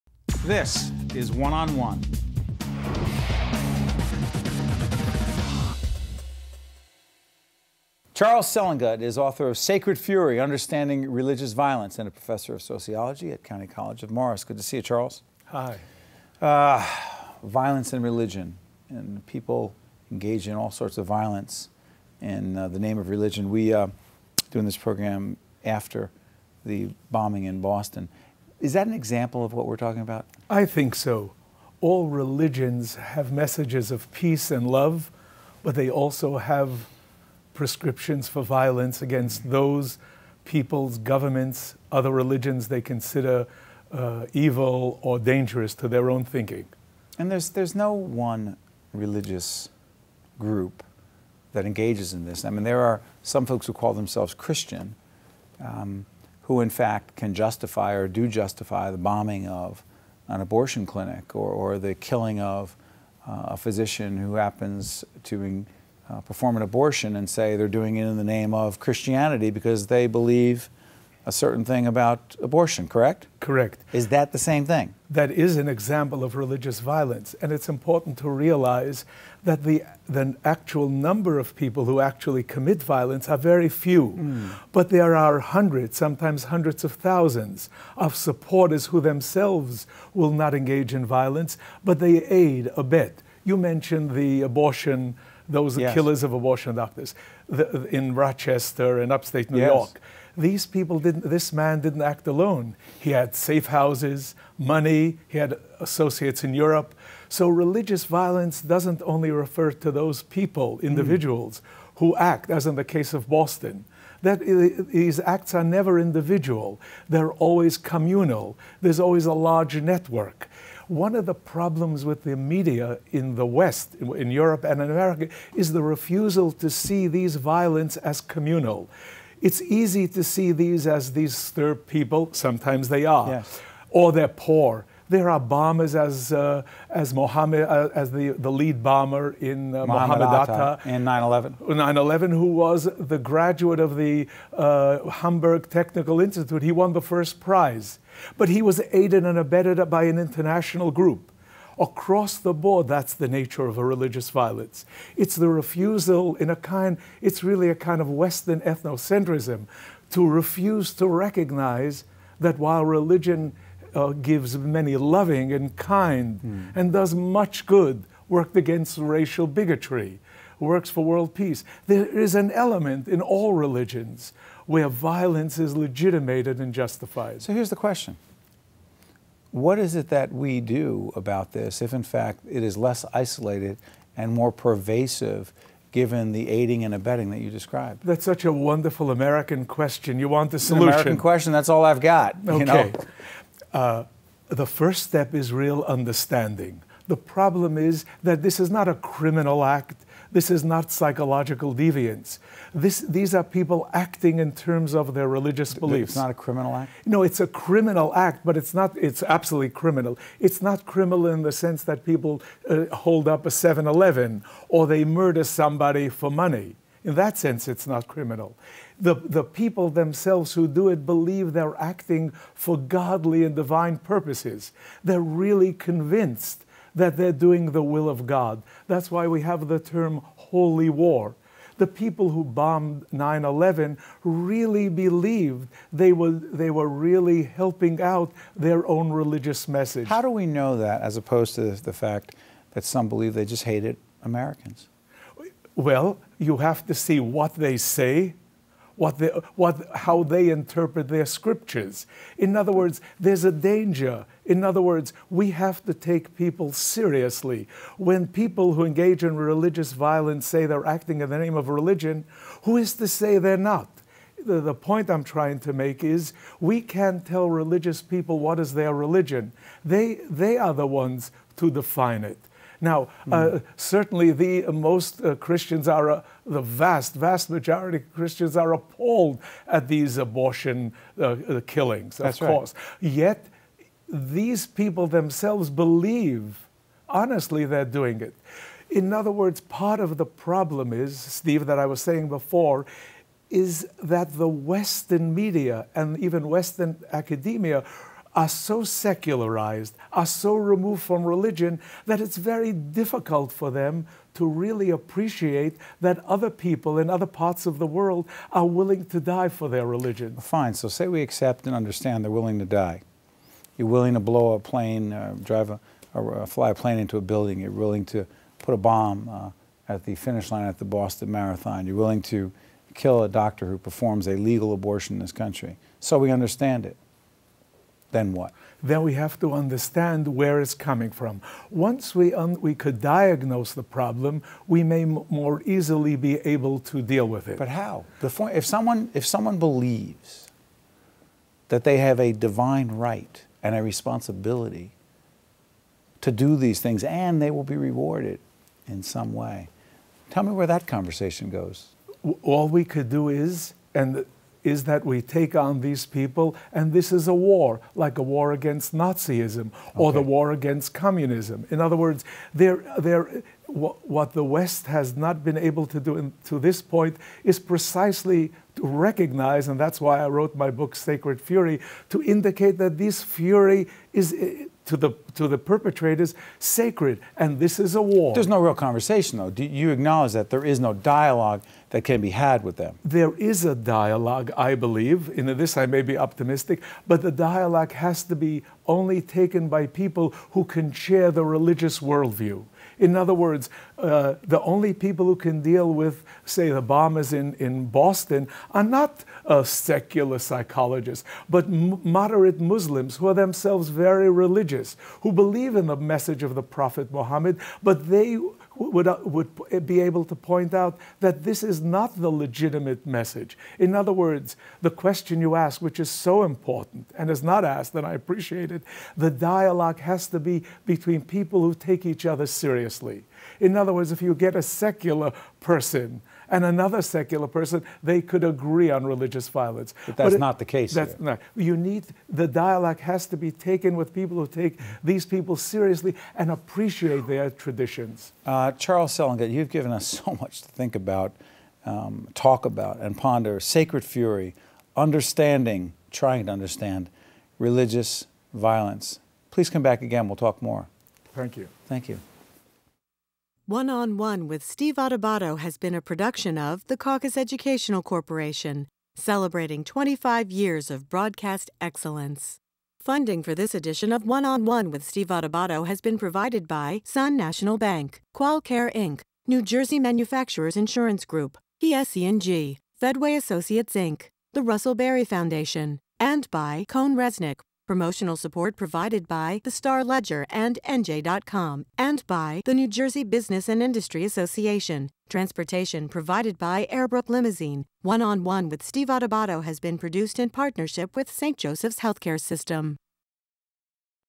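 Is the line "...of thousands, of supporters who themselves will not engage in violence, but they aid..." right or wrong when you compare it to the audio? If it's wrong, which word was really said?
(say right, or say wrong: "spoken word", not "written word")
right.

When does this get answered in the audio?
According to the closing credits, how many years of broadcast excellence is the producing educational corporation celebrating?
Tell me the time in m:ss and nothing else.
7:39.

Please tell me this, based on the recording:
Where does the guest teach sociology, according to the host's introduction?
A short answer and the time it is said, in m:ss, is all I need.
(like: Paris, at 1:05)
County College of Morris, at 0:13.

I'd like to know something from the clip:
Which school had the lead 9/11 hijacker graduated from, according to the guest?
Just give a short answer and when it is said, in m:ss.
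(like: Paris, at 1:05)
Hamburg Technical Institute, at 2:25.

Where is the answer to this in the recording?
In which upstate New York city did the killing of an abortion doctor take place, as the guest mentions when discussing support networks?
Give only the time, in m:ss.
1:38.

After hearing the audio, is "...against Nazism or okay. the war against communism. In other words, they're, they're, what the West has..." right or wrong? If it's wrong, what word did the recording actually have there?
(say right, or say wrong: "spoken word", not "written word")
right.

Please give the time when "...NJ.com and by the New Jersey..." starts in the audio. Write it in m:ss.
8:00.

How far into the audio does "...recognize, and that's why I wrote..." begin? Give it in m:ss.
6:08.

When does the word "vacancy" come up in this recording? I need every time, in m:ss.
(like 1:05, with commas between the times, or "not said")
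not said.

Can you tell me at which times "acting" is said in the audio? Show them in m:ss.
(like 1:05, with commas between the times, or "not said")
3:23, 3:41, 4:20.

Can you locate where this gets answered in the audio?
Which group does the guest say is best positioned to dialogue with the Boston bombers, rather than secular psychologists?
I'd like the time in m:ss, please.
6:41.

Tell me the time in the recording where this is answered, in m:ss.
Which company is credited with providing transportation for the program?
8:06.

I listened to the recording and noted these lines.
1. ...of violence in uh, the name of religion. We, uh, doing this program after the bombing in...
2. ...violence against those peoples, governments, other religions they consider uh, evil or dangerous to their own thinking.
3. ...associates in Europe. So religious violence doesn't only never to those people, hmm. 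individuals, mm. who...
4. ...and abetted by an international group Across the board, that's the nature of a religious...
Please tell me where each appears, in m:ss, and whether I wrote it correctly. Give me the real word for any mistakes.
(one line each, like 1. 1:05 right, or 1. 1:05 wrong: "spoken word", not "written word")
1. 0:20 right
2. 0:38 right
3. 1:45 wrong: "refer", not "never"
4. 2:29 right.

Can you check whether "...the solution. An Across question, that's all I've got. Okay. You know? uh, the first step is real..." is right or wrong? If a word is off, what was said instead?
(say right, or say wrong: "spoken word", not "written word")
wrong: "American", not "Across".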